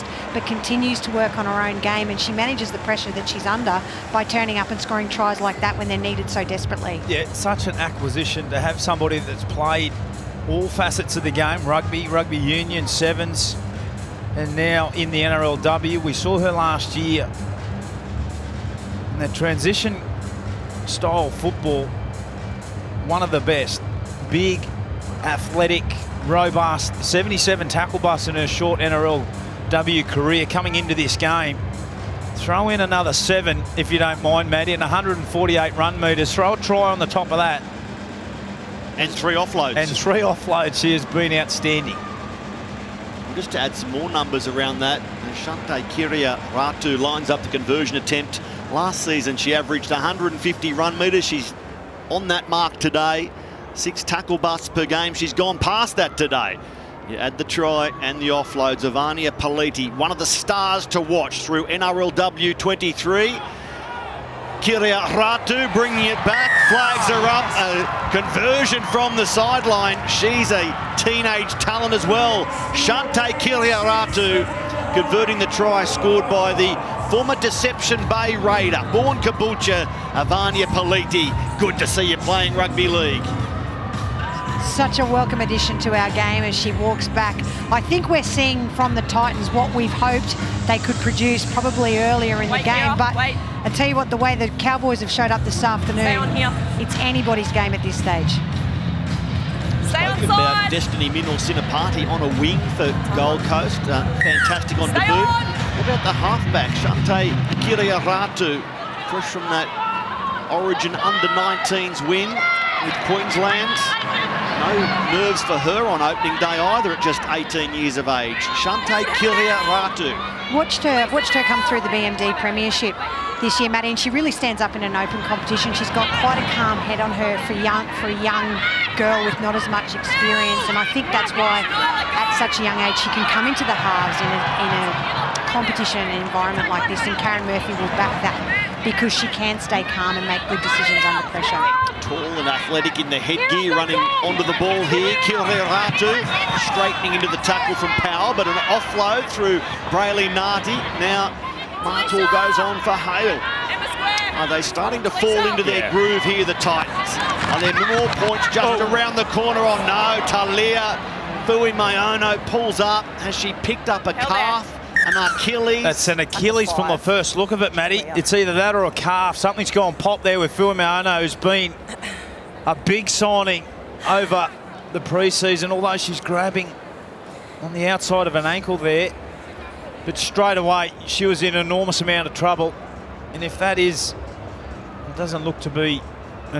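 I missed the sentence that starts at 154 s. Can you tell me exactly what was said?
Are they starting to fall into their groove here, the Titans?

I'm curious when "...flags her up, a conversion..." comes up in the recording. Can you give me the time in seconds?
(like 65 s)
66 s.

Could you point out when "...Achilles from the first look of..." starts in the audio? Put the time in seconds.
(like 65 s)
166 s.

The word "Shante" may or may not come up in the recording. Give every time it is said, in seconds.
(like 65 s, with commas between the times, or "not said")
45 s, 72 s, 106 s, 118 s.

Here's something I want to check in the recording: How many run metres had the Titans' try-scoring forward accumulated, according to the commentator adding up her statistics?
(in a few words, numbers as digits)
148.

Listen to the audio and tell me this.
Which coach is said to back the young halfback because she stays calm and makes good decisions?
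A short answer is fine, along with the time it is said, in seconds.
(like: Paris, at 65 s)
Karen Murphy, at 137 s.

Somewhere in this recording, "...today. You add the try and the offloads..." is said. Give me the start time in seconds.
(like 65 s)
56 s.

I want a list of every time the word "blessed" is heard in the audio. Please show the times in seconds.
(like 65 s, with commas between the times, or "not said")
not said.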